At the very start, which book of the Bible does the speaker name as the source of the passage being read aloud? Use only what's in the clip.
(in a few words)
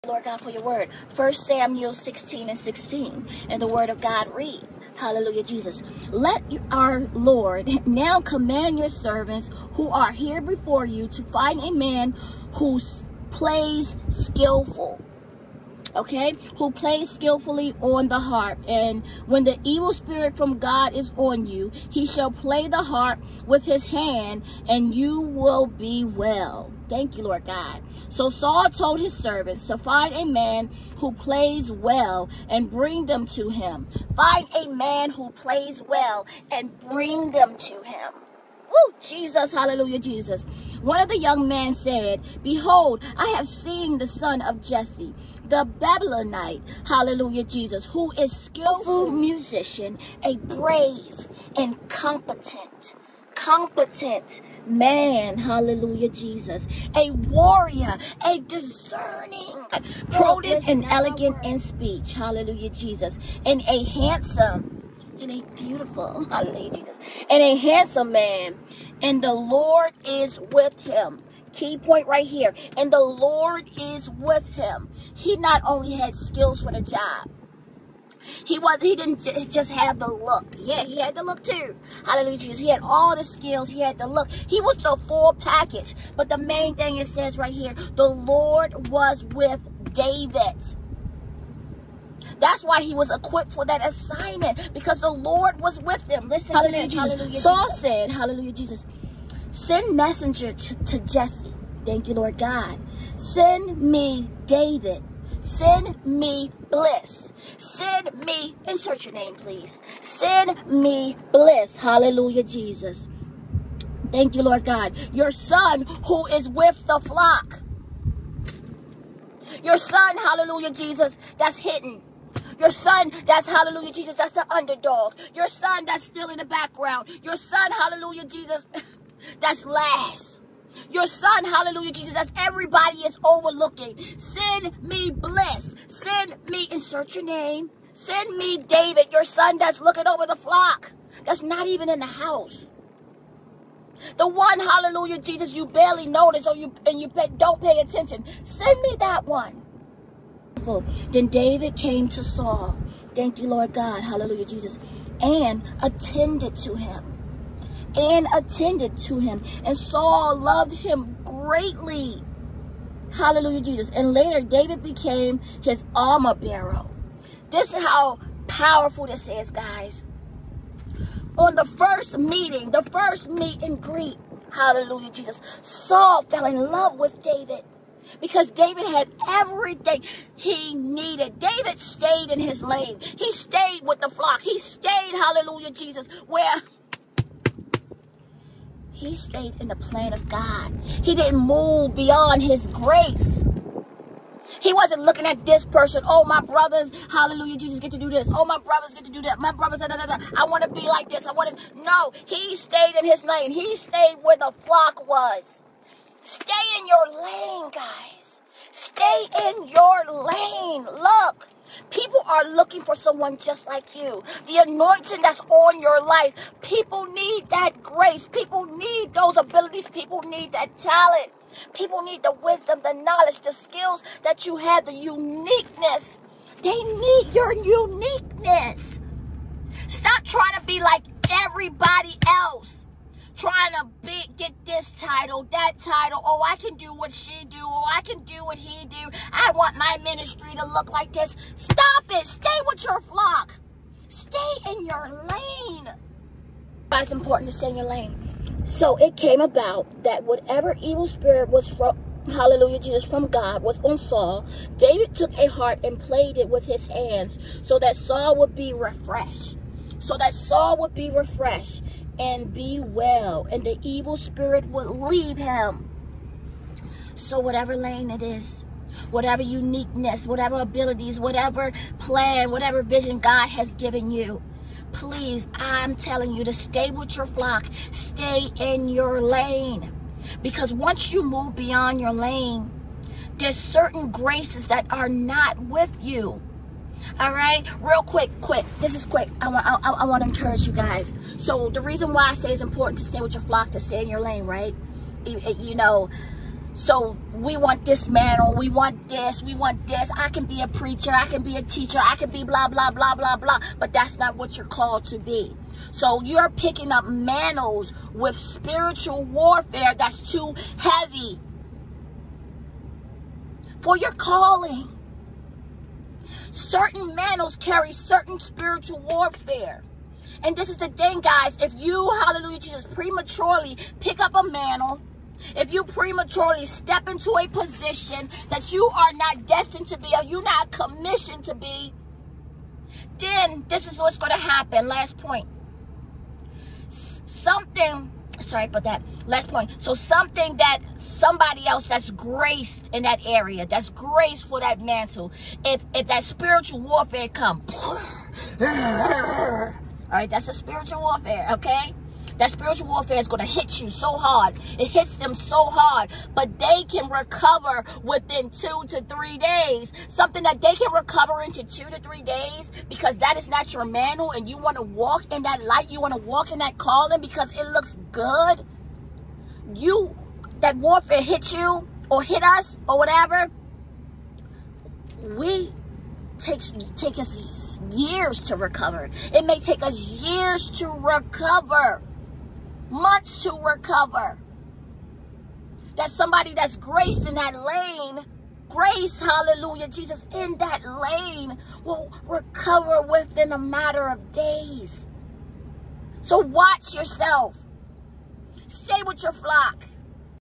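First Samuel.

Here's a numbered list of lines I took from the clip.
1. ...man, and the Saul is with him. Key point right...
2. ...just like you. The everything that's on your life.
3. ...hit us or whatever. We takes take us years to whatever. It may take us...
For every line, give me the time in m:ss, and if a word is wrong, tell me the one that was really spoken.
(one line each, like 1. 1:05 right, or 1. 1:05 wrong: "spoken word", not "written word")
1. 1:08 wrong: "Lord", not "Saul"
2. 3:33 wrong: "anointing", not "everything"
3. 6:12 wrong: "recover", not "whatever".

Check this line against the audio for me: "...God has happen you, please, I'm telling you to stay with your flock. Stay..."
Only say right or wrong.
wrong.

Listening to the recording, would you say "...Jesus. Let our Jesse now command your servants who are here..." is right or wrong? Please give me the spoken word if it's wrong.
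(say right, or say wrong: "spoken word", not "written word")
wrong: "Lord", not "Jesse".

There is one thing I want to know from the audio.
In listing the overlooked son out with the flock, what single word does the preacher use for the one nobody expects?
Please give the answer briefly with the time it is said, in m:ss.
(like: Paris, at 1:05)
Underdog, at 2:04.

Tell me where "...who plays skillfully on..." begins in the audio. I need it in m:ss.
0:16.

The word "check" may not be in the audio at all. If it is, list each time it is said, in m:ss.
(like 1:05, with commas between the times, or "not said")
not said.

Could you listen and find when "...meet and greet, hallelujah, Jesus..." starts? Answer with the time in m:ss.
2:53.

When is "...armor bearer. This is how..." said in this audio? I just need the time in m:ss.
2:45.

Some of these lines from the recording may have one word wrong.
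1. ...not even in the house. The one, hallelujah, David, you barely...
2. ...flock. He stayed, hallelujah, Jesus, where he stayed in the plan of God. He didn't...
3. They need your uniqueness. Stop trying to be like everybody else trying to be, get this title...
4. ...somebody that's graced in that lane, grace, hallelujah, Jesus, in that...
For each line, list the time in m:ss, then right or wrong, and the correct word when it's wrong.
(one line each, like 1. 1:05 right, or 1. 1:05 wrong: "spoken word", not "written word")
1. 2:21 wrong: "Jesus", not "David"
2. 3:04 right
3. 3:46 right
4. 6:26 right.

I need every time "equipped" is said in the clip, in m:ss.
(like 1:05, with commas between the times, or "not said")
1:33.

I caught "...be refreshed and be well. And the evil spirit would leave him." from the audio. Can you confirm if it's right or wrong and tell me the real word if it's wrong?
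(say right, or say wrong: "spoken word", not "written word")
right.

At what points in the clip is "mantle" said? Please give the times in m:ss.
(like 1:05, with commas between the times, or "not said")
4:58, 5:07, 5:17, 5:24, 5:44.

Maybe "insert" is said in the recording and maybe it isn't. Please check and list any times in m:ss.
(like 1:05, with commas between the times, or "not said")
1:48, 2:16.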